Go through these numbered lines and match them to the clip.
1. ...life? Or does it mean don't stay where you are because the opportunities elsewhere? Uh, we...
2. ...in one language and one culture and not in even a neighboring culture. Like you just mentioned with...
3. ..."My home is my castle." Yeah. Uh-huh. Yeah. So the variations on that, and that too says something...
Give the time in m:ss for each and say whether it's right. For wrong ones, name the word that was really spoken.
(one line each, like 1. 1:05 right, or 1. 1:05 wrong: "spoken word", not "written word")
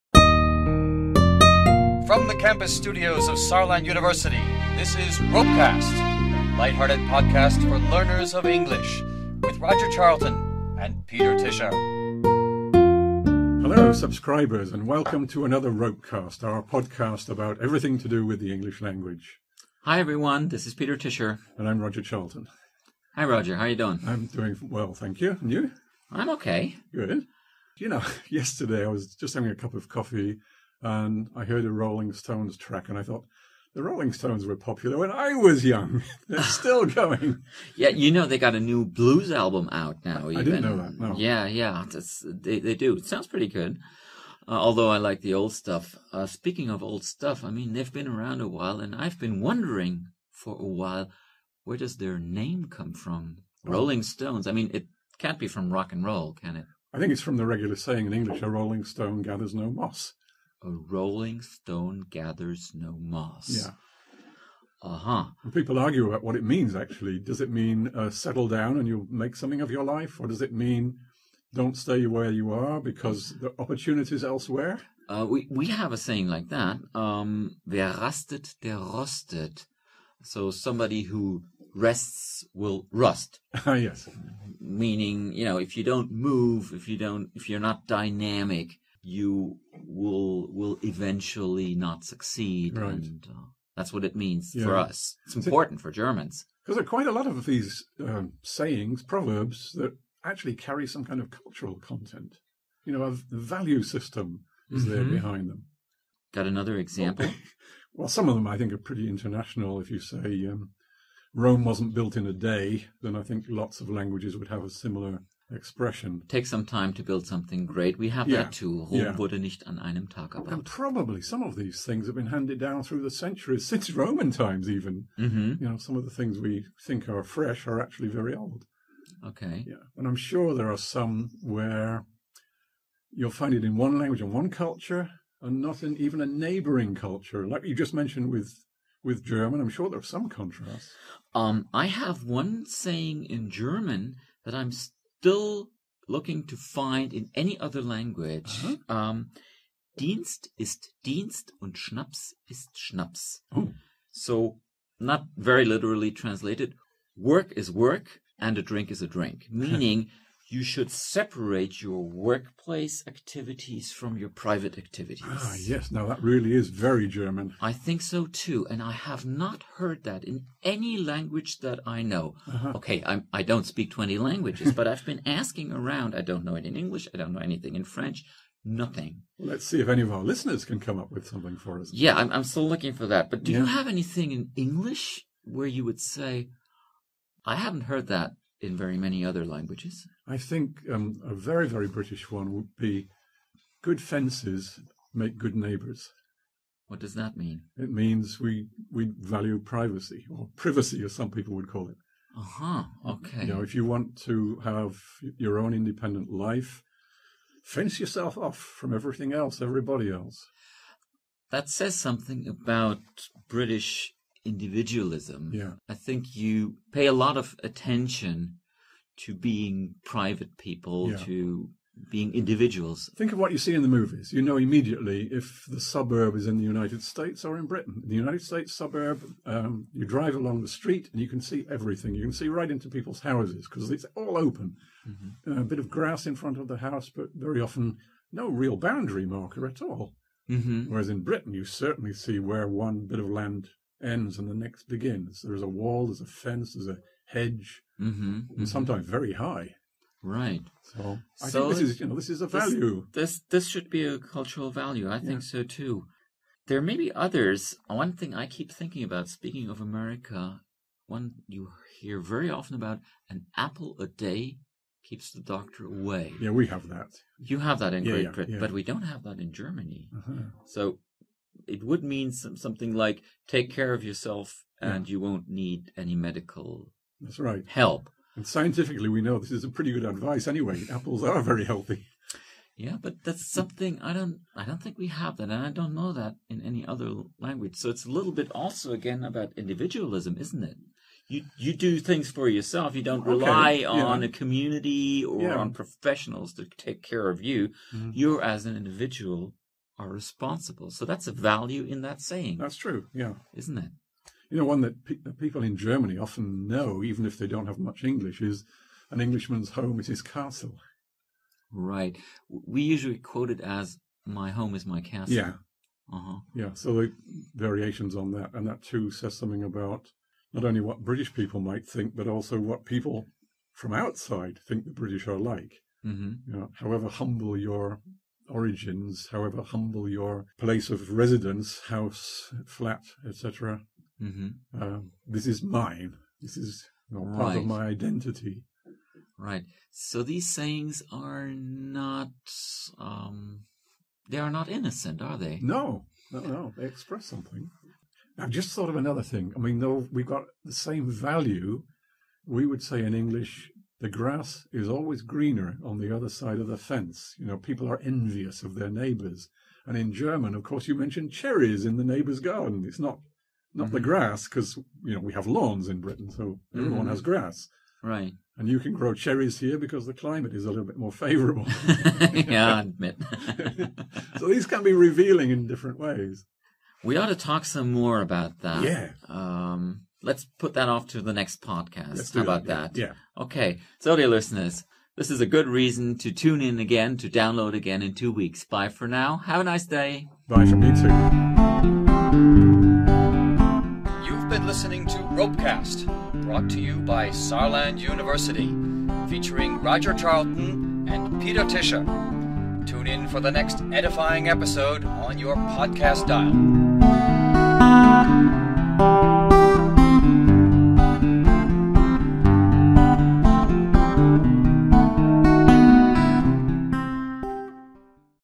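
1. 1:09 right
2. 2:13 right
3. 5:14 right.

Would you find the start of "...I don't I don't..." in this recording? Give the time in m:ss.
4:44.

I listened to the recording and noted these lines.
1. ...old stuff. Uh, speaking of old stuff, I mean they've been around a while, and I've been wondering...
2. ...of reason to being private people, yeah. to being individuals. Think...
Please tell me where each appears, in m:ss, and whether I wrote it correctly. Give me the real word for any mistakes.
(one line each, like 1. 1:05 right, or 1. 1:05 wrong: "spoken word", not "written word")
1. 0:45 right
2. 3:37 wrong: "attention", not "reason".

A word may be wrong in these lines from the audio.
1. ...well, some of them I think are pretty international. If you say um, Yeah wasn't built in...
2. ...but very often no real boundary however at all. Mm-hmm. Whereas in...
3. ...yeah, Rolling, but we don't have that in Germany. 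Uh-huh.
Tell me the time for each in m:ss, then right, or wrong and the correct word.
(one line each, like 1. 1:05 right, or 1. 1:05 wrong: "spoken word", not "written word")
1. 1:47 wrong: "Rome", not "Yeah"
2. 3:57 wrong: "marker", not "however"
3. 4:28 wrong: "Britain", not "Rolling".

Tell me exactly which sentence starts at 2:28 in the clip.
um, Dienst ist Dienst und Schnaps ist Schnaps.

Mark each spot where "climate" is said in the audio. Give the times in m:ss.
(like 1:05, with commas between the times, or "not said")
6:10.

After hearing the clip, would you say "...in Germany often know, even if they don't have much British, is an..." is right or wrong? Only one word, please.
wrong.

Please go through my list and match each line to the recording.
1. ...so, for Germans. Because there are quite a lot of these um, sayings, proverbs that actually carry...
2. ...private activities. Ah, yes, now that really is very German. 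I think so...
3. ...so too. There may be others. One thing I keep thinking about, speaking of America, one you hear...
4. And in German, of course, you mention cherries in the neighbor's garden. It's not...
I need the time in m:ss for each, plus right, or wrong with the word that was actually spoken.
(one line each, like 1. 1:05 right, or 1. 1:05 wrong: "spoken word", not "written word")
1. 1:35 right
2. 2:44 right
3. 4:15 right
4. 5:59 right.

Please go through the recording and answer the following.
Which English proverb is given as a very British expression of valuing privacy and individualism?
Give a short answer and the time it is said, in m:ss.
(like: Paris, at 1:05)
good fences make good neighbours, at 3:13.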